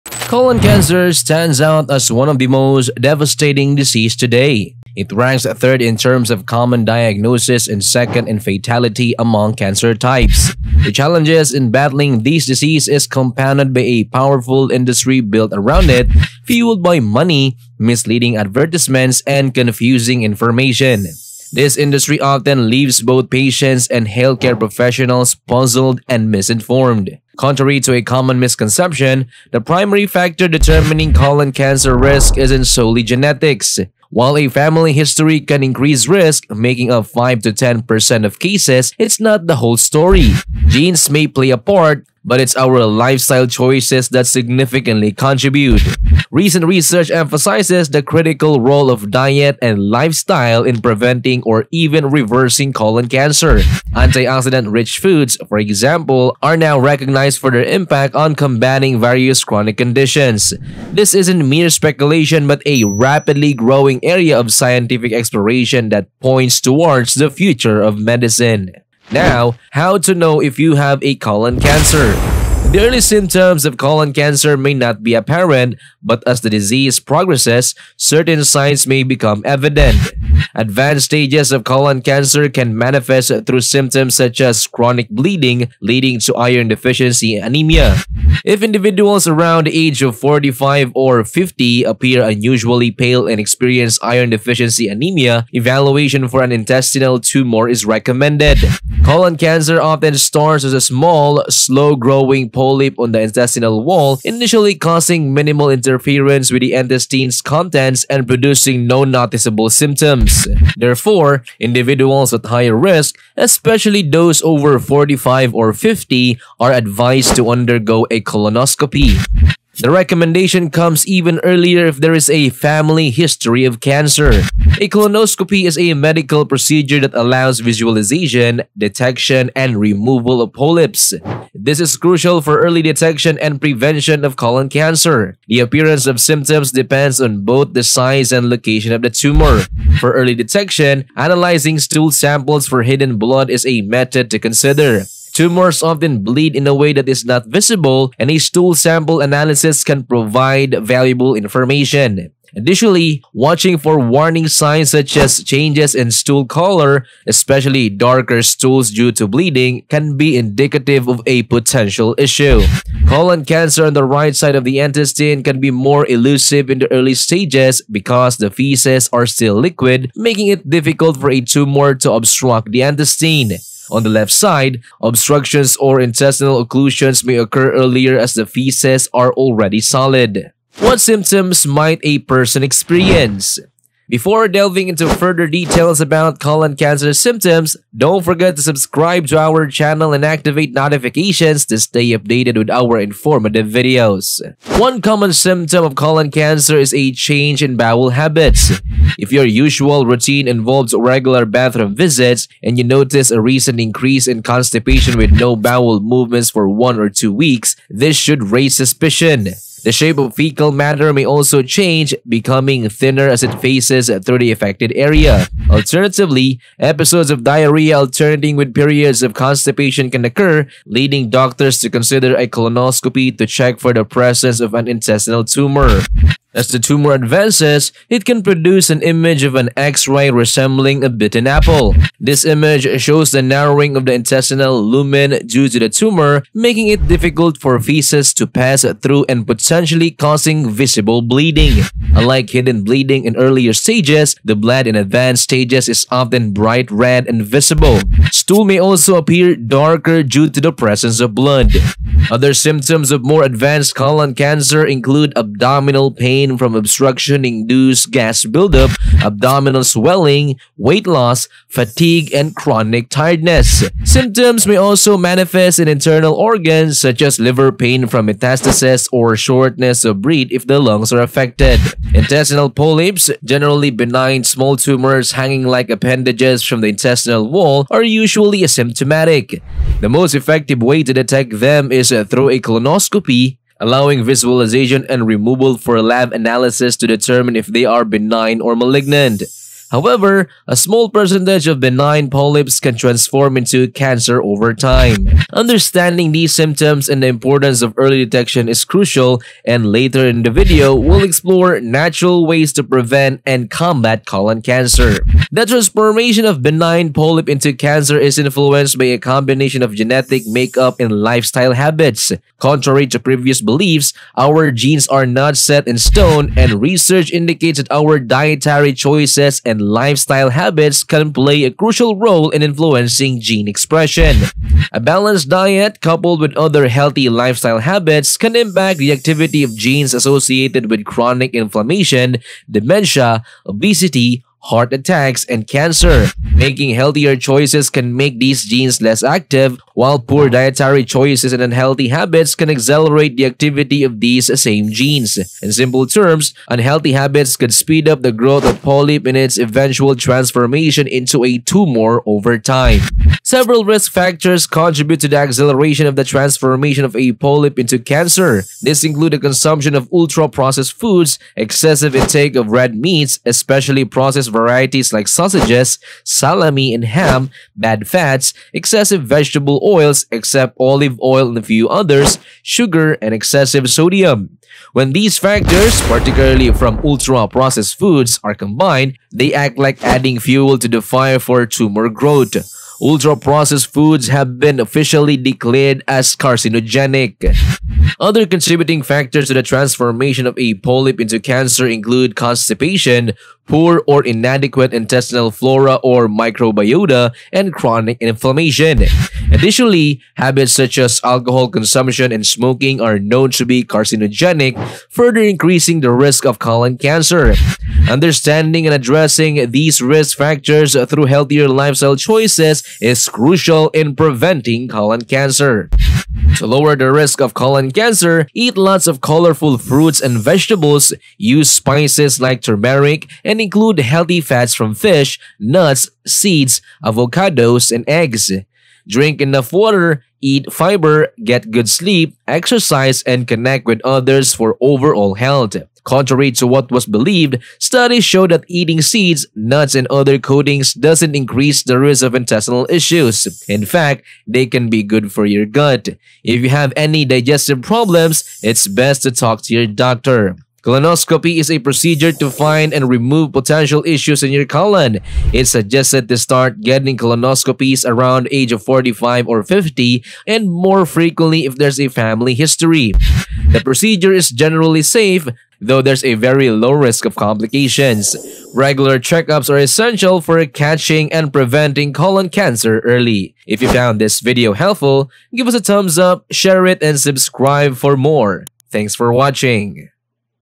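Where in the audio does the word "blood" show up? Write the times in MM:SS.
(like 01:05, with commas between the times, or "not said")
02:23, 04:04, 04:11.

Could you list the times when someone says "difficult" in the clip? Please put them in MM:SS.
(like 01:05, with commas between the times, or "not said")
02:50, 03:57.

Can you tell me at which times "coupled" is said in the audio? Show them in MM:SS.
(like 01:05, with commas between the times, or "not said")
05:26.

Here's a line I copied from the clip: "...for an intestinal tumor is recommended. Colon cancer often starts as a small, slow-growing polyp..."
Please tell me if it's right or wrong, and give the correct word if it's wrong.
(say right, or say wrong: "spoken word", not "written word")
right.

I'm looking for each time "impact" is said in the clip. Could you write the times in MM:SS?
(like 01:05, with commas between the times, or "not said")
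00:57, 05:28.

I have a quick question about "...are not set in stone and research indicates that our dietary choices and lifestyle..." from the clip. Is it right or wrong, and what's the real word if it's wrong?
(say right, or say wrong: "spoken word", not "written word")
right.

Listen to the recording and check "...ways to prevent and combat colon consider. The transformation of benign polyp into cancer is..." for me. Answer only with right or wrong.
wrong.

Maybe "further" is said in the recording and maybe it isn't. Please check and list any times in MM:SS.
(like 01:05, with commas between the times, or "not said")
03:05, 06:45.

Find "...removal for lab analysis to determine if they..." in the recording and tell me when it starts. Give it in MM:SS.
04:45.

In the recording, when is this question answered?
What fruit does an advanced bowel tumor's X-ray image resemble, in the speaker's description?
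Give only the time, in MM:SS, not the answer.
03:51.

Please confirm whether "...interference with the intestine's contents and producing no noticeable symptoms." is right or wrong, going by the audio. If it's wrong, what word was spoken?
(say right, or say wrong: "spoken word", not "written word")
right.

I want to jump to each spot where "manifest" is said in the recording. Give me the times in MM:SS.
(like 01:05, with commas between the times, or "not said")
01:22, 04:25.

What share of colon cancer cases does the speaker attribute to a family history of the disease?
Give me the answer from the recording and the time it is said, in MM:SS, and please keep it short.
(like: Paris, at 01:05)
5 to 10%, at 00:37.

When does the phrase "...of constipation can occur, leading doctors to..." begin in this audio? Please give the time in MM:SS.
03:39.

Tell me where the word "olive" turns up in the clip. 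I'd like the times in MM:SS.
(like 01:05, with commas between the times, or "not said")
06:10.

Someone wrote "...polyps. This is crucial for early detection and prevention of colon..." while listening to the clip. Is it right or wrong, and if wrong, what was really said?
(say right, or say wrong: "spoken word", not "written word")
right.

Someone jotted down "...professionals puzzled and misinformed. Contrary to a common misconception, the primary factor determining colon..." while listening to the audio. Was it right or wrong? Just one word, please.
right.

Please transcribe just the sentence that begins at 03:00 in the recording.
What symptoms might a person experience?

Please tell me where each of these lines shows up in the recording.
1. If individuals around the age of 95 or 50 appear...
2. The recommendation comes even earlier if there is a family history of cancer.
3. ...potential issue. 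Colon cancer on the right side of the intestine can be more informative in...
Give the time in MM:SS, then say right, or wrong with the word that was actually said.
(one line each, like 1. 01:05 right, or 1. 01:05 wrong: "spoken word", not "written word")
1. 01:28 wrong: "45", not "95"
2. 01:59 right
3. 02:41 wrong: "elusive", not "informative".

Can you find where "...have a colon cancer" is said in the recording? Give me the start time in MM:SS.
01:10.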